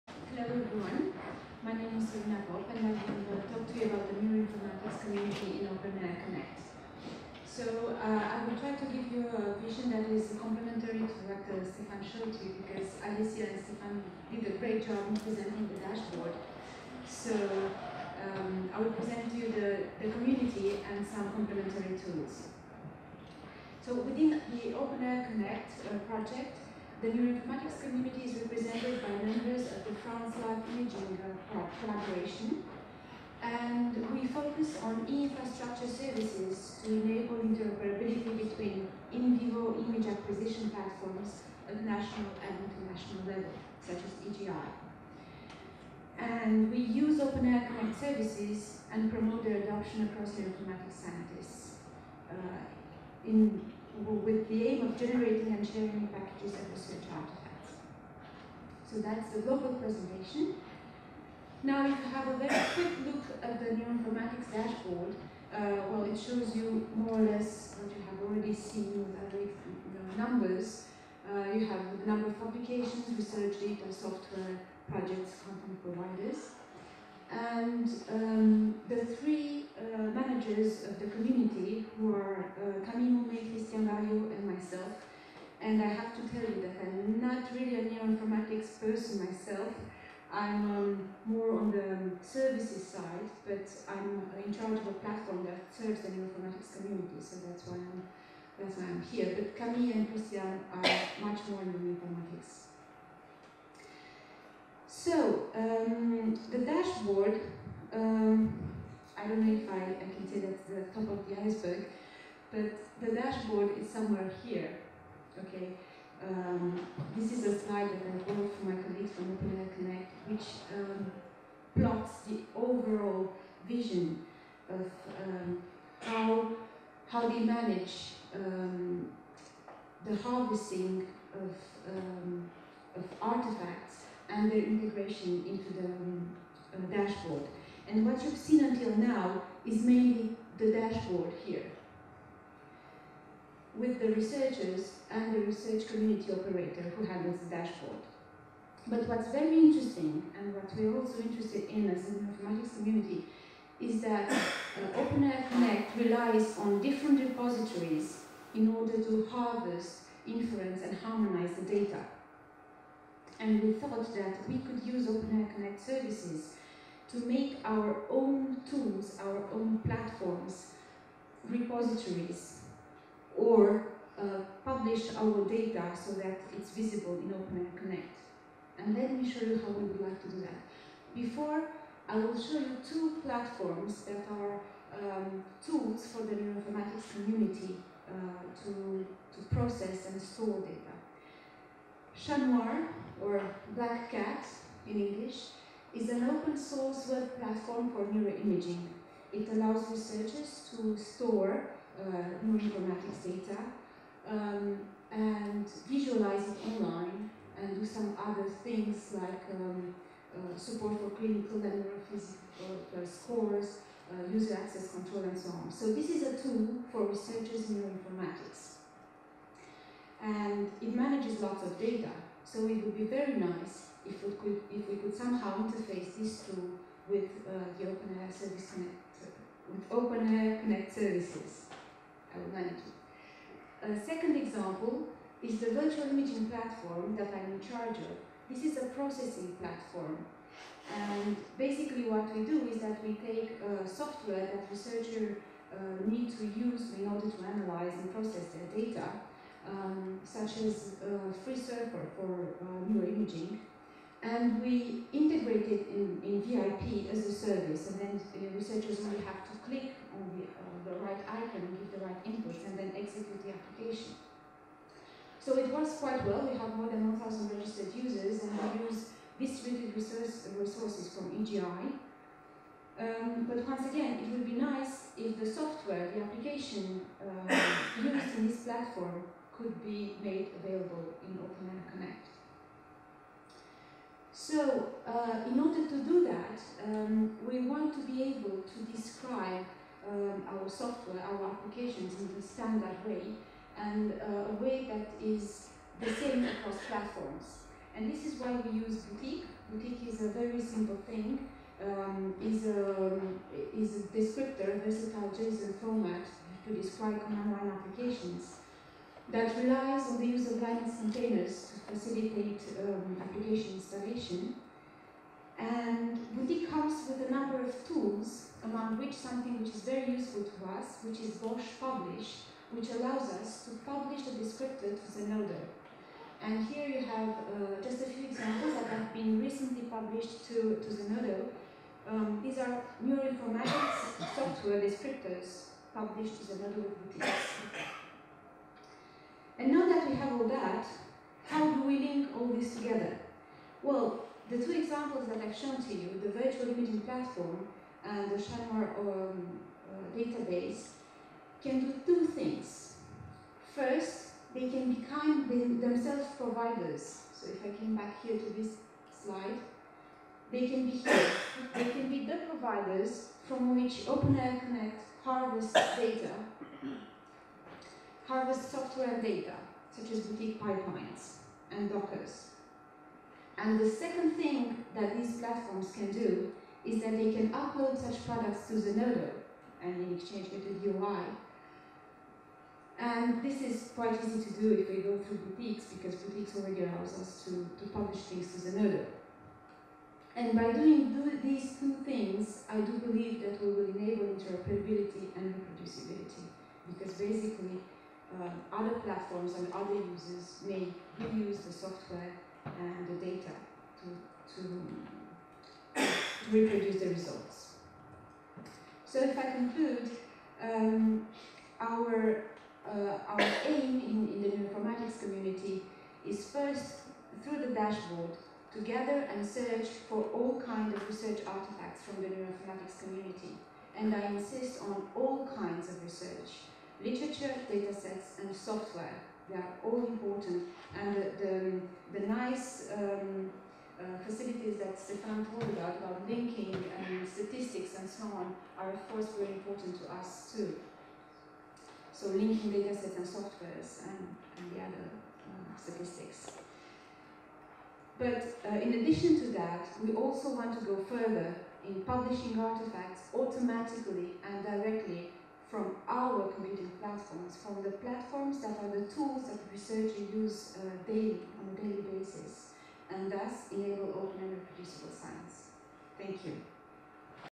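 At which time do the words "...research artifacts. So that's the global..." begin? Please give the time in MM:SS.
00:56.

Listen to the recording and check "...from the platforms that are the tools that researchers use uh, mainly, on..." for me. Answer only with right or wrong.
wrong.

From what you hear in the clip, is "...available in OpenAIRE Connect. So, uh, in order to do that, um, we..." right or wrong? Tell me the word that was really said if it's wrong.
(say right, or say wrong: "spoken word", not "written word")
right.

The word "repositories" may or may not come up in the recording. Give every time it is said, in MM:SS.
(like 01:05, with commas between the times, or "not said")
02:37, 02:51.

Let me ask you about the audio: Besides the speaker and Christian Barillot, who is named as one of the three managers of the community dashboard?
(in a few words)
Camille Maumet.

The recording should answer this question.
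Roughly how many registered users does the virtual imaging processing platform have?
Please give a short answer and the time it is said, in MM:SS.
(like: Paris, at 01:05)
More than 1,000, at 04:26.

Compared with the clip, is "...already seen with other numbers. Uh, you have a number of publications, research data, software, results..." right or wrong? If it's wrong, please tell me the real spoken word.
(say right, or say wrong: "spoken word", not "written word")
wrong: "projects", not "results".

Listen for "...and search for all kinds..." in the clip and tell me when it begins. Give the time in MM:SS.
06:59.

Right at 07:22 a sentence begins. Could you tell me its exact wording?
So linking data sets and softwares and, and the other uh, statistics.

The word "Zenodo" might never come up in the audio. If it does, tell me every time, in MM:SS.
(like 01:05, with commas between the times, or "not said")
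05:30, 05:36, 06:18, 06:28.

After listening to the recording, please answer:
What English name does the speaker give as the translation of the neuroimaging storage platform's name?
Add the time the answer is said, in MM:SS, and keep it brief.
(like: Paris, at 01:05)
Black Cat, at 03:13.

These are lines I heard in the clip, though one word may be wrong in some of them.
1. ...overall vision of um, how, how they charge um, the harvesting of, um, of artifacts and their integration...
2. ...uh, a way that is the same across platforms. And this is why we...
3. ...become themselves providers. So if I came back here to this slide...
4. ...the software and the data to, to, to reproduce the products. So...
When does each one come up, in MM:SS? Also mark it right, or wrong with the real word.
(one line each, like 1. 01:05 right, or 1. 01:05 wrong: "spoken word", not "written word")
1. 02:02 wrong: "manage", not "charge"
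2. 04:54 right
3. 05:54 right
4. 06:41 wrong: "results", not "products".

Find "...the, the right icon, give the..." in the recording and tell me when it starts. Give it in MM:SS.
04:20.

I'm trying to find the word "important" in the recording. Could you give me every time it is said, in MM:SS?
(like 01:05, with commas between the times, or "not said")
07:10, 07:19.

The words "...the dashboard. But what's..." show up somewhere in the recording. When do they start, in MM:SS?
02:27.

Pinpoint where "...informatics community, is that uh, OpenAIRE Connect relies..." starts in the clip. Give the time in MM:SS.
02:32.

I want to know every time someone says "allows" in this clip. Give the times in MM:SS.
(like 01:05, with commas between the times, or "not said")
03:19, 05:22, 06:26.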